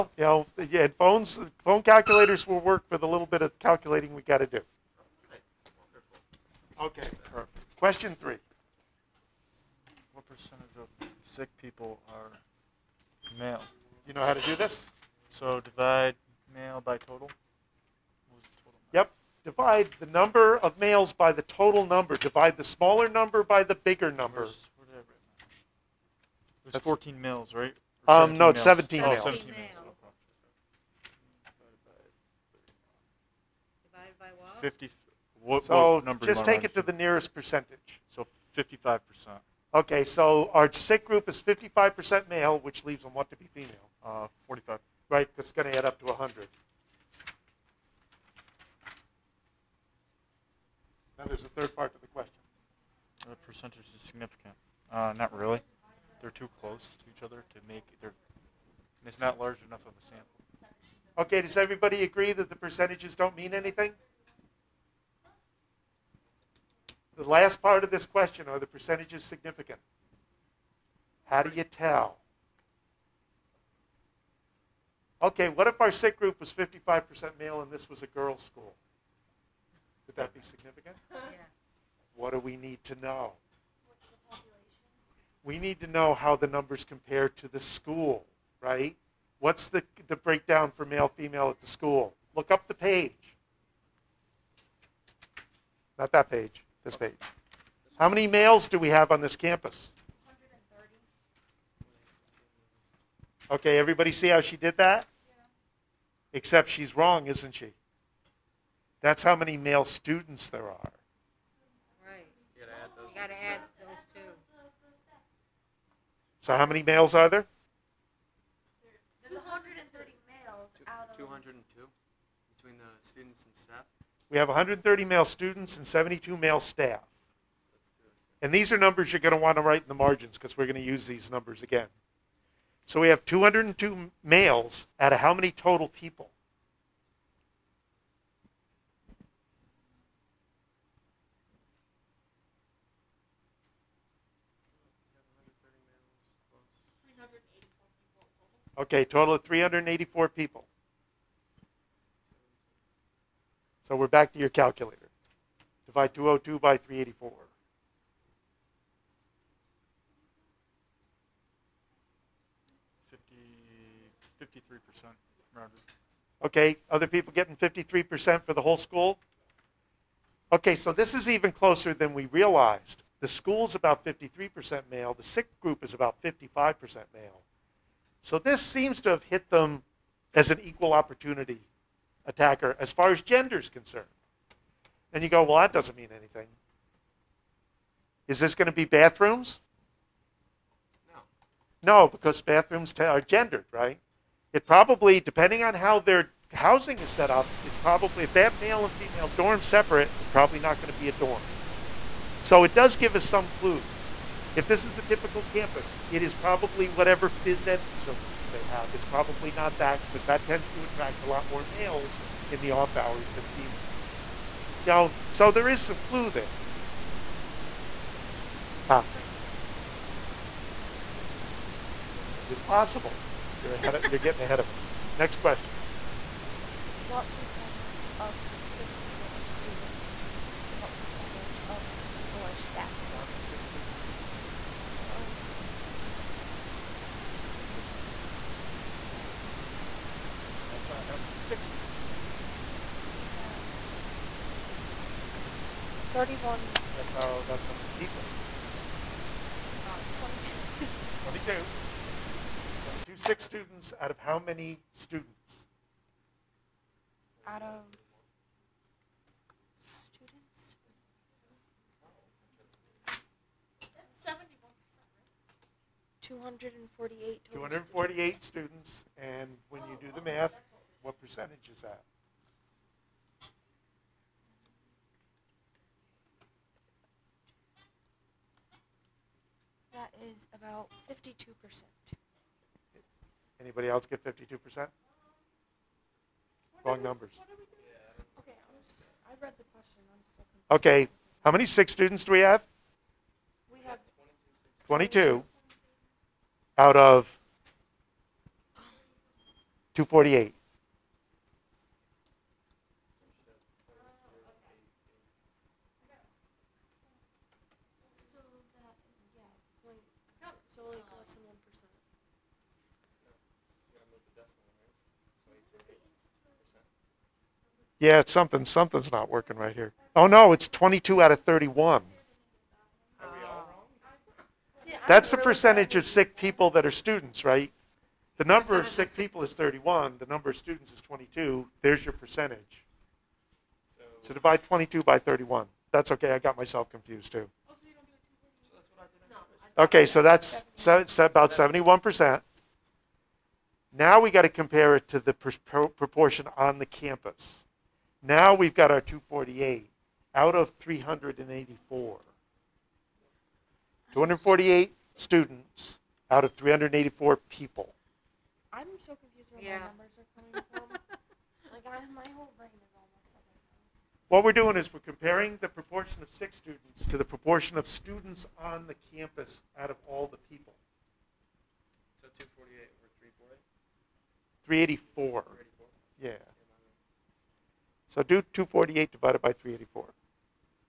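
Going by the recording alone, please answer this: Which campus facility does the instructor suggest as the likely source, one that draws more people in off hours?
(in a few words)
phys ed facilities.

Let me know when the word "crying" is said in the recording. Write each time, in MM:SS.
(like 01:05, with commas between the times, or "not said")
not said.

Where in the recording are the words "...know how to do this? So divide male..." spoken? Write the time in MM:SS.
00:14.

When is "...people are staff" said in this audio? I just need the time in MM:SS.
03:52.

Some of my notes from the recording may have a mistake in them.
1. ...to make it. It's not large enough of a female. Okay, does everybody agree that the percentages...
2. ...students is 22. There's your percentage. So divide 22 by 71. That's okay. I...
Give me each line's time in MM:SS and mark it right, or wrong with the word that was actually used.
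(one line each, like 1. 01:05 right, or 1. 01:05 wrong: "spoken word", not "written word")
1. 00:57 wrong: "sample", not "female"
2. 05:30 wrong: "31", not "71".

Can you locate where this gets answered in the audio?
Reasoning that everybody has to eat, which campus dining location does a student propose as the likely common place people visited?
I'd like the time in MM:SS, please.
03:42.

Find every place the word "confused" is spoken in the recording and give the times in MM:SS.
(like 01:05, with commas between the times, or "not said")
05:36, 05:59.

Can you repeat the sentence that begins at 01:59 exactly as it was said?
There's 130 males two, out of 202 between the students and staff.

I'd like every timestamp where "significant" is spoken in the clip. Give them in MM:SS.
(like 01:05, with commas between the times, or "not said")
00:54, 01:09, 01:20.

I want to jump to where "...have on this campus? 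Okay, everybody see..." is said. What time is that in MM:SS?
01:38.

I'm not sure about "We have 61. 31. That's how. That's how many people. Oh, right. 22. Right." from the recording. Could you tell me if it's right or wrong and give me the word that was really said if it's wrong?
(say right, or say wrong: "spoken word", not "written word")
wrong: "31", not "61".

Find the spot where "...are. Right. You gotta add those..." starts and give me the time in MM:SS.
01:50.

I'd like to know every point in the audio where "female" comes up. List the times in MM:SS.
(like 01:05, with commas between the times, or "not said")
00:43, 01:31, 03:18, 03:33.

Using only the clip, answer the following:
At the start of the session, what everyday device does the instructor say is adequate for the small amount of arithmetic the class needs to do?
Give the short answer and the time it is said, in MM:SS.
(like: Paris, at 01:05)
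phone calculators, at 00:01.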